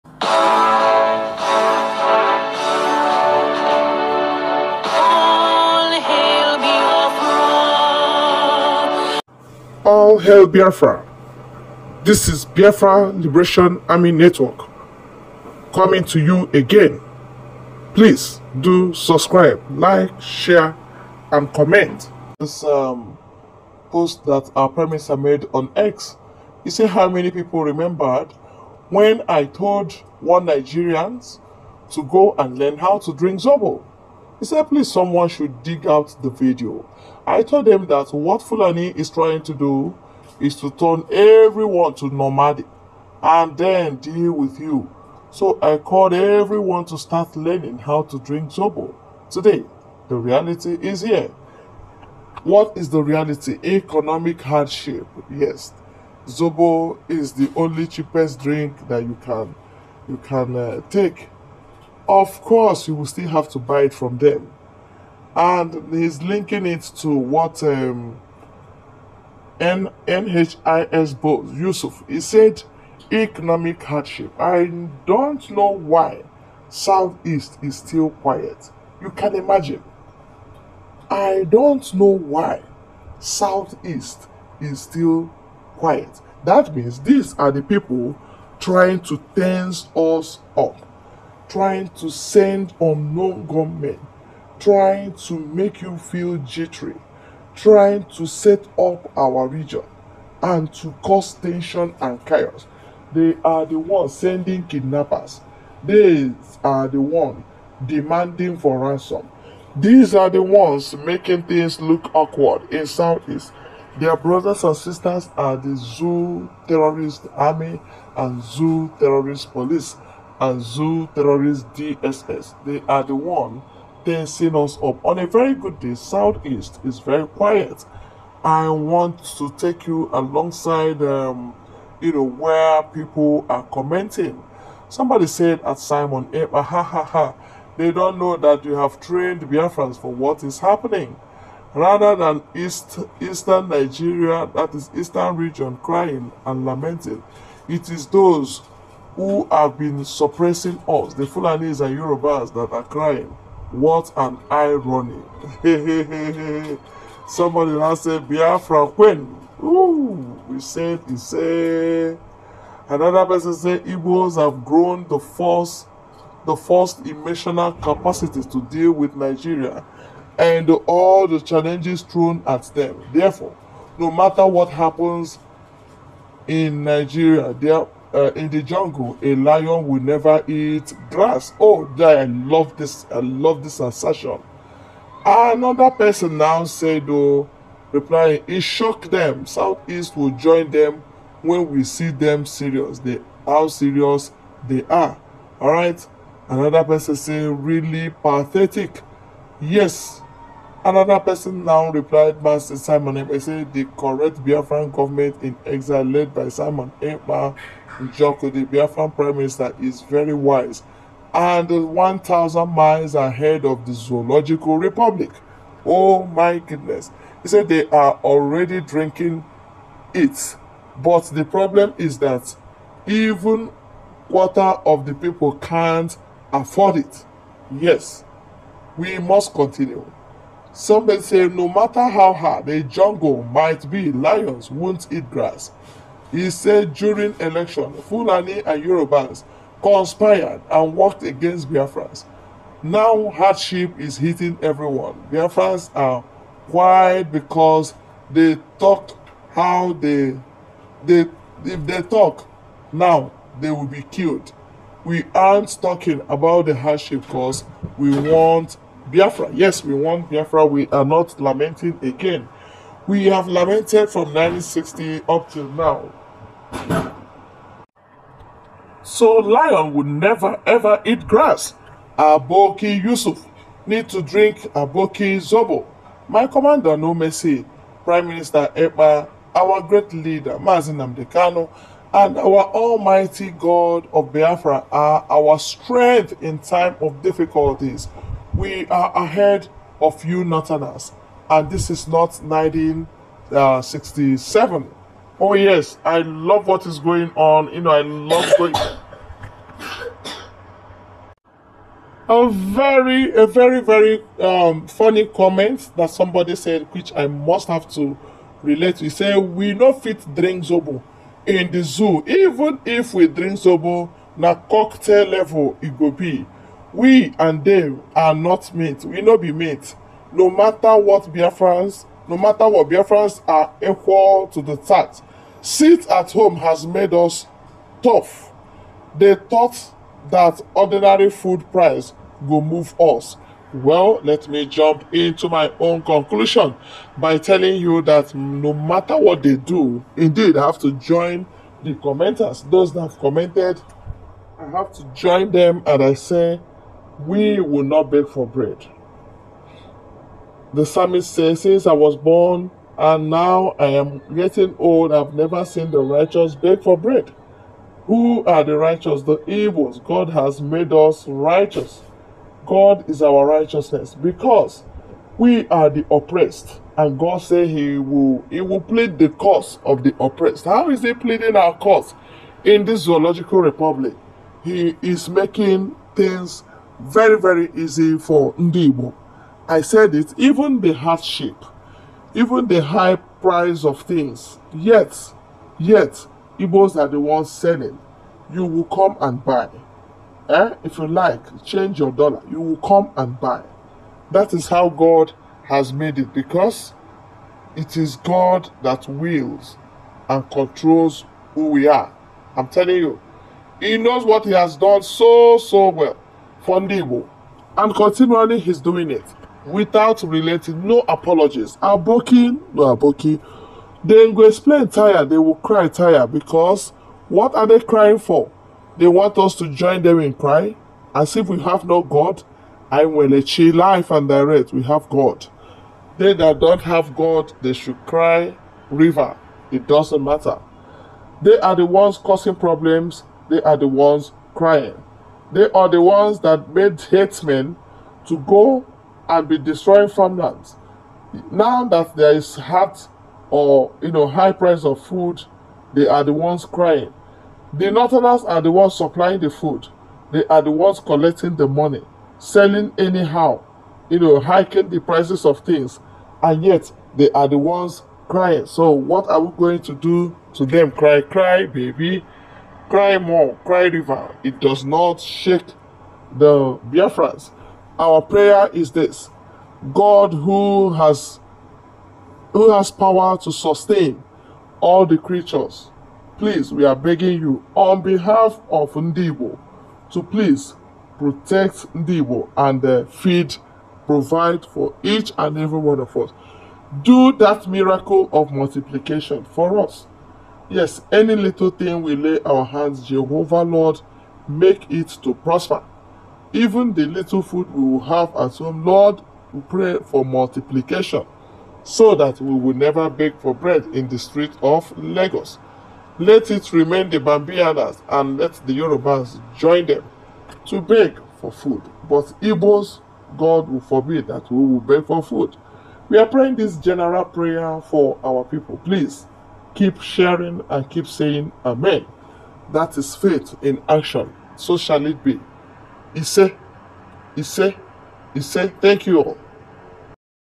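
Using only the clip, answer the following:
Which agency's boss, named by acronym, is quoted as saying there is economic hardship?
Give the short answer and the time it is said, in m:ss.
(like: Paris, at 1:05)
NHIS, at 1:09.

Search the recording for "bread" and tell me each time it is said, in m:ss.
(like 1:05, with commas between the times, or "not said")
5:48, 5:56, 8:23.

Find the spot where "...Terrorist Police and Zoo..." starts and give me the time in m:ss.
1:58.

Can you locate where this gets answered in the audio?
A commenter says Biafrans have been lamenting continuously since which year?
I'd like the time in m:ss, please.
4:24.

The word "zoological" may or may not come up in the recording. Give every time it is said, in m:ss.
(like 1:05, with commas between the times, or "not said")
3:33, 6:13.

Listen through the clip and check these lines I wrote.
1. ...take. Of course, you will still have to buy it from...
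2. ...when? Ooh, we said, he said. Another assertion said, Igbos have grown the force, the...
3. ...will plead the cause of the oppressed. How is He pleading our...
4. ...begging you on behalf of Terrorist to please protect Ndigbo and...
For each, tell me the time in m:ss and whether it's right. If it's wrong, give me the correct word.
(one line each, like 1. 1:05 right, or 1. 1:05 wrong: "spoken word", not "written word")
1. 1:00 right
2. 2:38 wrong: "person", not "assertion"
3. 6:08 right
4. 7:56 wrong: "Ndigbo", not "Terrorist".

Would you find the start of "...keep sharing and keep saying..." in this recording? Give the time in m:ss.
8:39.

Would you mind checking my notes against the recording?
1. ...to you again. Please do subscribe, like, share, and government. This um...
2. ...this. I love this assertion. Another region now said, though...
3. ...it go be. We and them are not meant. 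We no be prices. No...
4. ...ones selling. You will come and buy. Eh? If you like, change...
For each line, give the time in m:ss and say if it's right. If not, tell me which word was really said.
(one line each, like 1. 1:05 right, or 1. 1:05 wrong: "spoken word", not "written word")
1. 0:16 wrong: "comment", not "government"
2. 3:02 wrong: "person", not "region"
3. 5:15 wrong: "mates", not "prices"
4. 6:27 right.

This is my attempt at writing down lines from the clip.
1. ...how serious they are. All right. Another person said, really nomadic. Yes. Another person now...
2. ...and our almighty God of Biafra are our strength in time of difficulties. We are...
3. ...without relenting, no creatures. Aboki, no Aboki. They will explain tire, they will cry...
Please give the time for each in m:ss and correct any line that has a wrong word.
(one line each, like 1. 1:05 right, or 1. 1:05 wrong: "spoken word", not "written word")
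1. 3:13 wrong: "pathetic", not "nomadic"
2. 4:42 right
3. 6:49 wrong: "apologies", not "creatures".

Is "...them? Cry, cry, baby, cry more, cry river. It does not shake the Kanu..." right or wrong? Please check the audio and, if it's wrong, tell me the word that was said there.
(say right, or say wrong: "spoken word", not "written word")
wrong: "Biafrans", not "Kanu".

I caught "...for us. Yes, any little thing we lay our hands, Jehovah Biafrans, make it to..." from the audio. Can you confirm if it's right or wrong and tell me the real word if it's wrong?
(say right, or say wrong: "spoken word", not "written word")
wrong: "Lord", not "Biafrans".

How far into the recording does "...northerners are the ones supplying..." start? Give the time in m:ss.
7:27.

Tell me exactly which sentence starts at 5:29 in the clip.
They thought that ordinary food price will move us.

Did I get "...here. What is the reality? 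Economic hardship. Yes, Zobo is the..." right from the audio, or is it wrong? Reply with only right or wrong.
right.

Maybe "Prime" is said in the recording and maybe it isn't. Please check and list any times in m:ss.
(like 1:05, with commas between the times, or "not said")
0:24, 3:29, 4:38.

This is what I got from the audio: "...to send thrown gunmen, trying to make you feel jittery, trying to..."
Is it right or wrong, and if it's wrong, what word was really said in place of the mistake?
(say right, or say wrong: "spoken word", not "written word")
wrong: "unknown", not "thrown".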